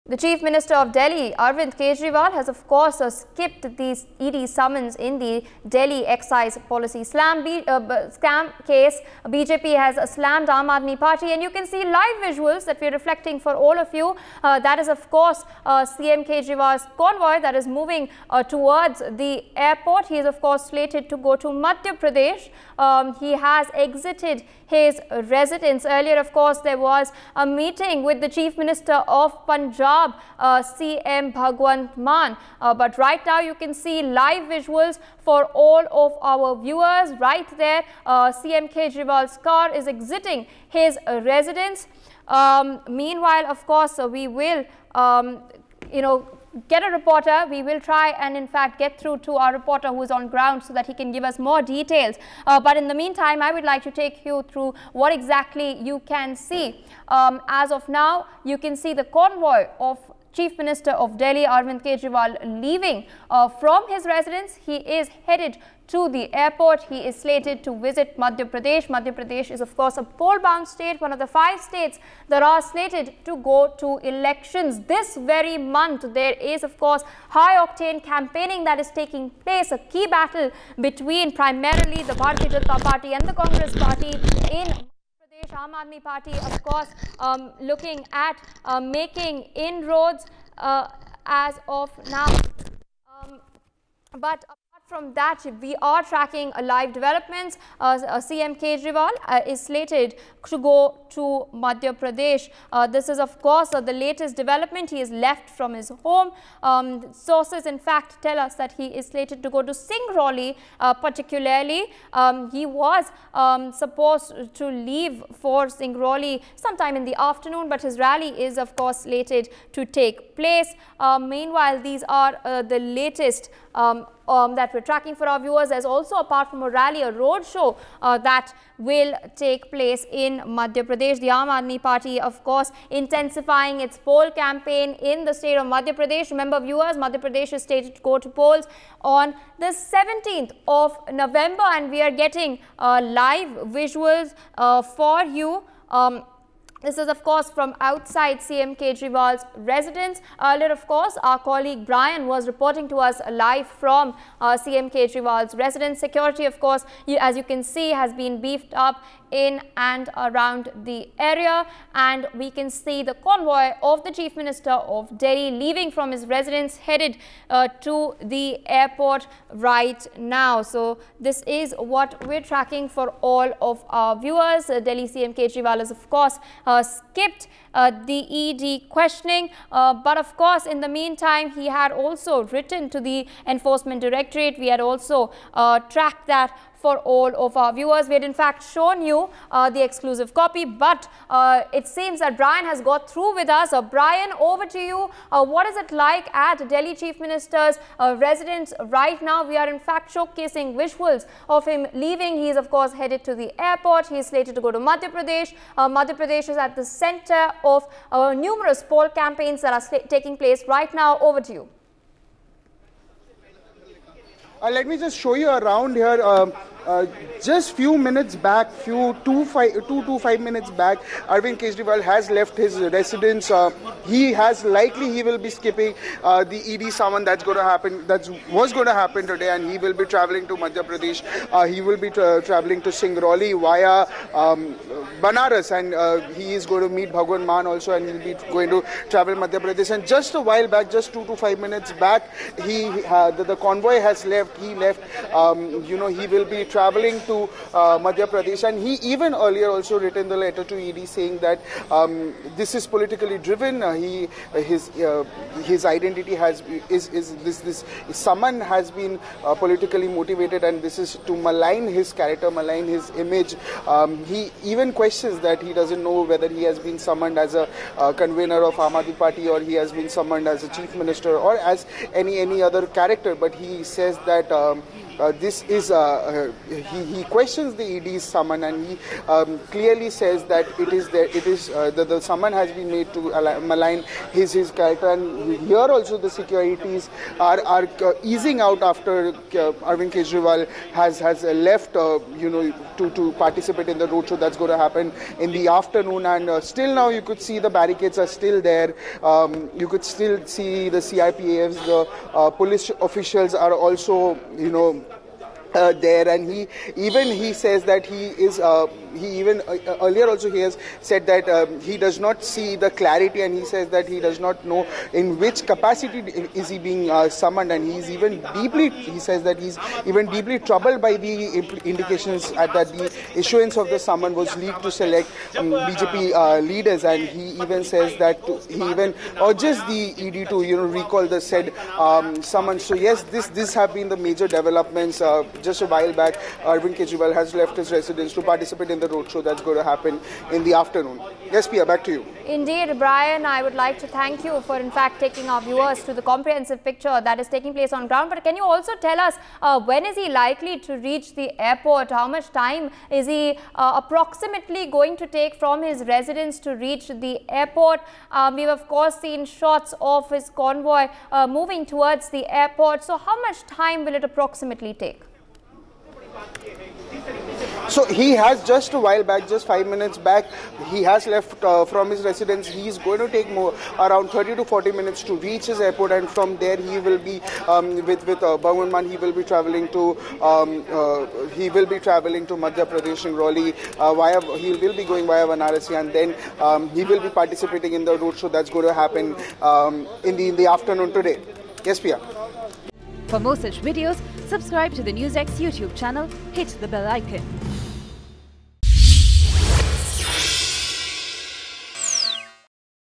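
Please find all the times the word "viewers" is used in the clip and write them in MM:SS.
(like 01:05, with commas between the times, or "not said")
00:36, 02:05, 02:16, 02:54, 03:07, 05:45.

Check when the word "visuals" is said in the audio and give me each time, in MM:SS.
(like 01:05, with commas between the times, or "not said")
00:12, 00:34, 02:23, 03:20.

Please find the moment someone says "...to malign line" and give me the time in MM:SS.
04:43.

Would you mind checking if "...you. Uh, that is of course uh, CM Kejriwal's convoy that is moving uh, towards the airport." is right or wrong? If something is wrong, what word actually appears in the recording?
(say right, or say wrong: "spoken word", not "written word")
right.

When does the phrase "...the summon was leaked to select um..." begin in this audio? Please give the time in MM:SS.
05:23.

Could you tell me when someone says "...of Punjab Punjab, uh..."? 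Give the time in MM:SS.
00:29.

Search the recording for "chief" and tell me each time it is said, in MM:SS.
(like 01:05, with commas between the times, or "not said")
00:00, 00:28, 01:00, 02:44, 03:16, 04:30.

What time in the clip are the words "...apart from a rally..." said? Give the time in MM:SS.
02:06.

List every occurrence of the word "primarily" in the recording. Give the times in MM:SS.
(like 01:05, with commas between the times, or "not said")
01:21.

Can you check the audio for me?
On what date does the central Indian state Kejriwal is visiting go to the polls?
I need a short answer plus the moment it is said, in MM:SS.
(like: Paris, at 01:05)
17th of November, at 02:19.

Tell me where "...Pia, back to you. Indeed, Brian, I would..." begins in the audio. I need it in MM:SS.
05:41.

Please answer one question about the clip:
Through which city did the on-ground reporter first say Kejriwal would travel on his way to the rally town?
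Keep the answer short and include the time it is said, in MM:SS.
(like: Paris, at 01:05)
Banaras, at 03:55.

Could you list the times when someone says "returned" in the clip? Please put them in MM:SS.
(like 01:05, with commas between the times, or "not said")
not said.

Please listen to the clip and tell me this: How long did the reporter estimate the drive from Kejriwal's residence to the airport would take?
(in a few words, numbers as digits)
30 to 40 minutes.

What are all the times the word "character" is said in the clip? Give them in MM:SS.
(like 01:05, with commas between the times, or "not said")
04:22, 04:32, 04:44.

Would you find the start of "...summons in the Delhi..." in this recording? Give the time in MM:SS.
00:04.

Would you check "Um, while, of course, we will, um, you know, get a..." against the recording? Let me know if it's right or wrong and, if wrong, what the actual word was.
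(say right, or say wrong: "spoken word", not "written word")
wrong: "meanwhile", not "while".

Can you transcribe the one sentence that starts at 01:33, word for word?
Um, but from that, we are tracking live developments.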